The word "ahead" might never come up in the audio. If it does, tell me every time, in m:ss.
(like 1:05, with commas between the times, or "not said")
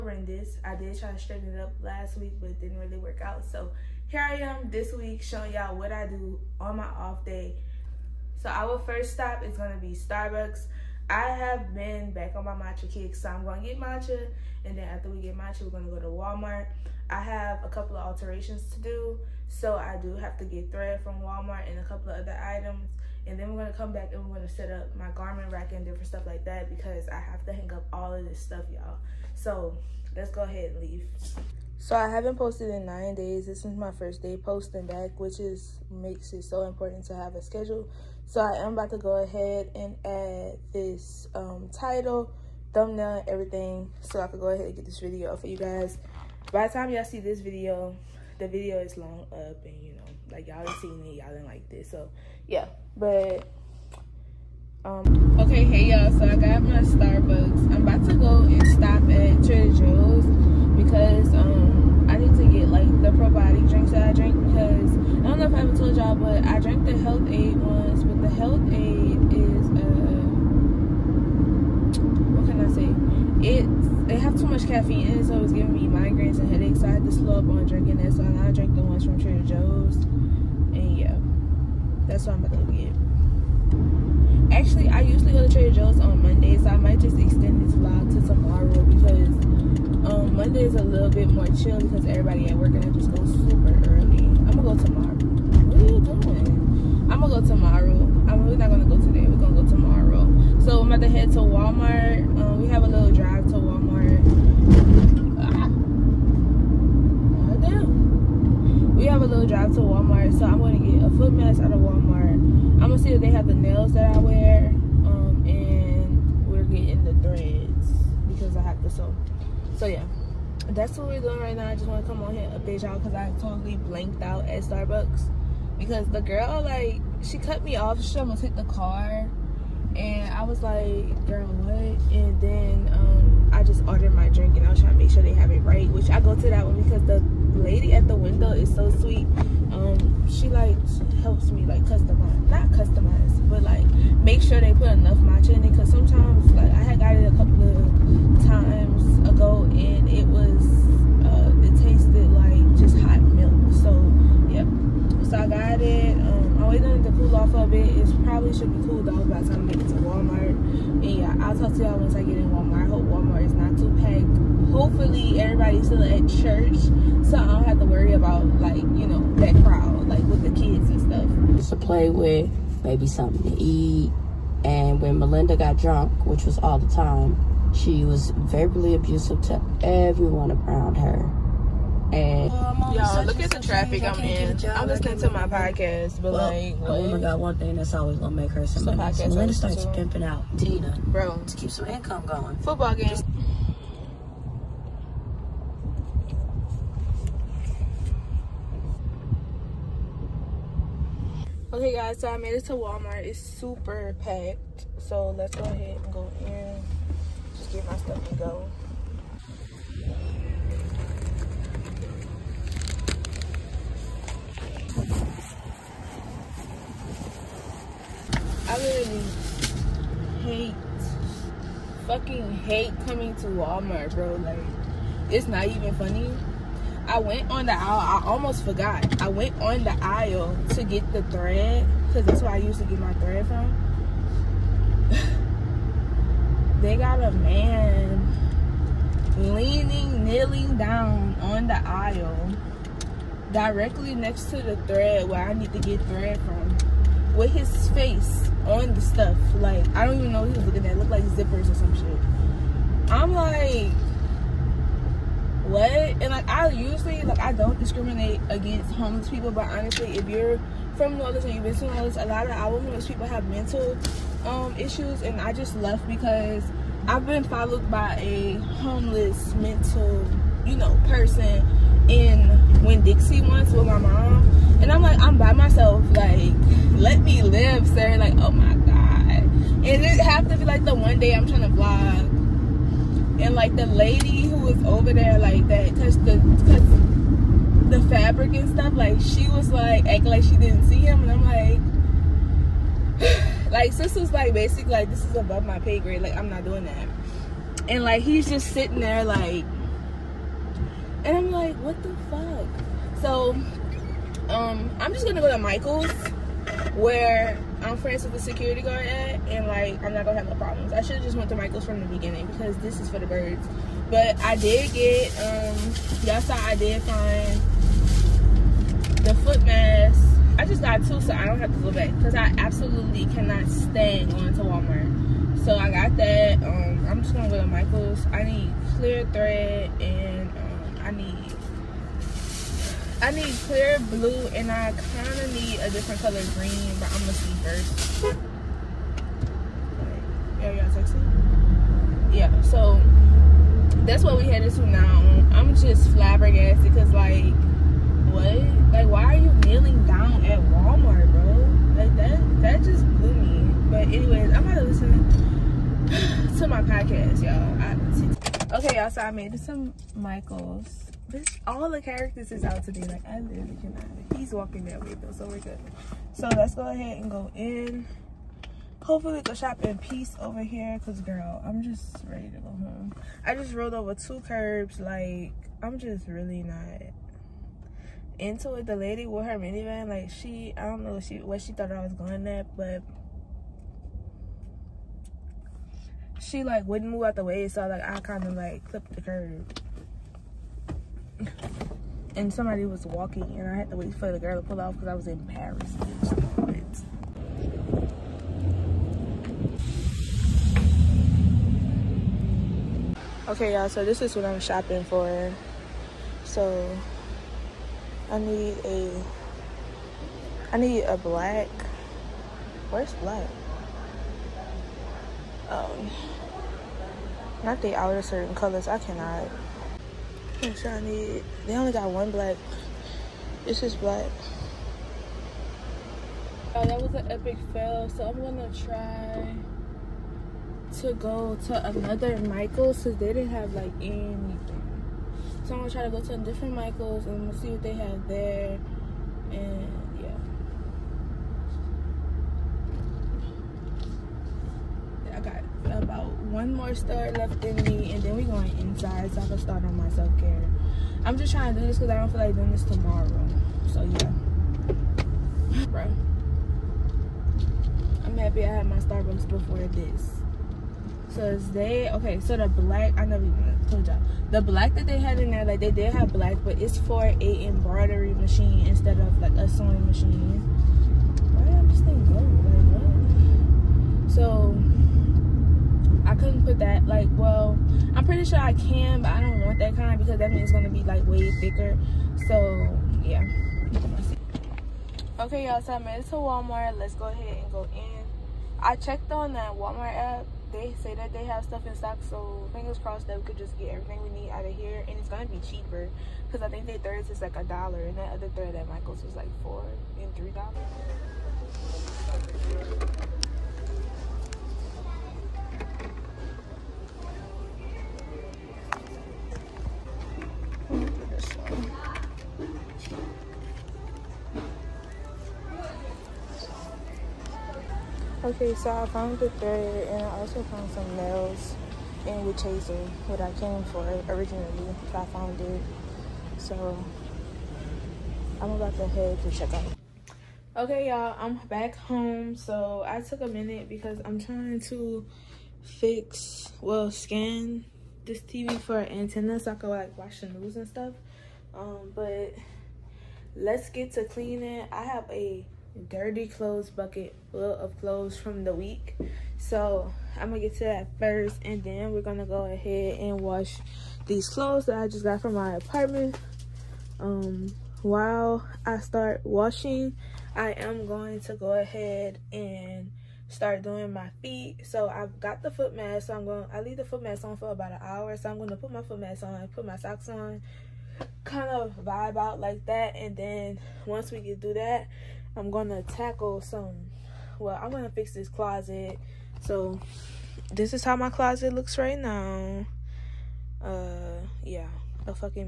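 0:30, 0:39, 0:44, 3:25, 6:06, 8:07, 9:12, 9:21.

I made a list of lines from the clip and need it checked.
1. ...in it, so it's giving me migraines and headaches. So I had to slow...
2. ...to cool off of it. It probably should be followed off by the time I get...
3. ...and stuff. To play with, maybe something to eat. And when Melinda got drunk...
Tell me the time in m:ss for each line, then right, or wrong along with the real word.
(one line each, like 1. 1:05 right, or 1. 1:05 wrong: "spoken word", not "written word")
1. 1:15 right
2. 2:37 wrong: "cooled", not "followed"
3. 2:50 right.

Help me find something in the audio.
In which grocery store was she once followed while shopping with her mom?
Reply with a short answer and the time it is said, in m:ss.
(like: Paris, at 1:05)
Winn Dixie, at 4:32.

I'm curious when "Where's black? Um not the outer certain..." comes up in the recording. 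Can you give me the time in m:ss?
6:52.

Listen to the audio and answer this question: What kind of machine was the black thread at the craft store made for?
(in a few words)
Embroidery machine.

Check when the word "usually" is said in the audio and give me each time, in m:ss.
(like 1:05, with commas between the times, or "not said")
1:25, 4:16.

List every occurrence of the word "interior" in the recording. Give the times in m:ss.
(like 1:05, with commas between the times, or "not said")
not said.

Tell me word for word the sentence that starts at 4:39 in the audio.
And it happened to be like the one day I'm trying to vlog.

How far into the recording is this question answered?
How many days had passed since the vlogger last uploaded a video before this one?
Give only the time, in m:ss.
0:32.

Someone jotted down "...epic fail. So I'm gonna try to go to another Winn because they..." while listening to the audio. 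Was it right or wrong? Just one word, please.
wrong.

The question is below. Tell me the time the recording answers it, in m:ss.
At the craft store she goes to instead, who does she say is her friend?
5:08.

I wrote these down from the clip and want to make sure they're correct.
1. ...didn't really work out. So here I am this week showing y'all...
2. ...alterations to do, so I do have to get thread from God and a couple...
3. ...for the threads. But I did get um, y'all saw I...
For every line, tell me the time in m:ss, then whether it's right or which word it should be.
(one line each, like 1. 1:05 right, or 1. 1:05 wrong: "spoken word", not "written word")
1. 0:02 right
2. 0:18 wrong: "Walmart", not "God"
3. 5:13 wrong: "birds", not "threads".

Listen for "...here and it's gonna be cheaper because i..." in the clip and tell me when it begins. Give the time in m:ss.
8:14.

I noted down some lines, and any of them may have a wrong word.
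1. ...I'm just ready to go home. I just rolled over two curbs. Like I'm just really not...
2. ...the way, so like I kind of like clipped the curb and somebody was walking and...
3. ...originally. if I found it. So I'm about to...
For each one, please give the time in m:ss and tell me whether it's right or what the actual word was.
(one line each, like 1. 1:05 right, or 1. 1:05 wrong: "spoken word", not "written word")
1. 6:11 right
2. 6:27 right
3. 8:44 right.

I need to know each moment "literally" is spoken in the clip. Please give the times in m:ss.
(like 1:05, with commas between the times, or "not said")
3:38, 6:03.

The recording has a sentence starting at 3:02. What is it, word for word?
And y'all, look at the traffic I'm in.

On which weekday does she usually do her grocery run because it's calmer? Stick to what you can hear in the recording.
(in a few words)
Monday.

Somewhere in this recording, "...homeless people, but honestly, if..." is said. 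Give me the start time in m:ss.
4:18.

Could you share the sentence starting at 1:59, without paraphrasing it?
So yeah that's what we're doing right now.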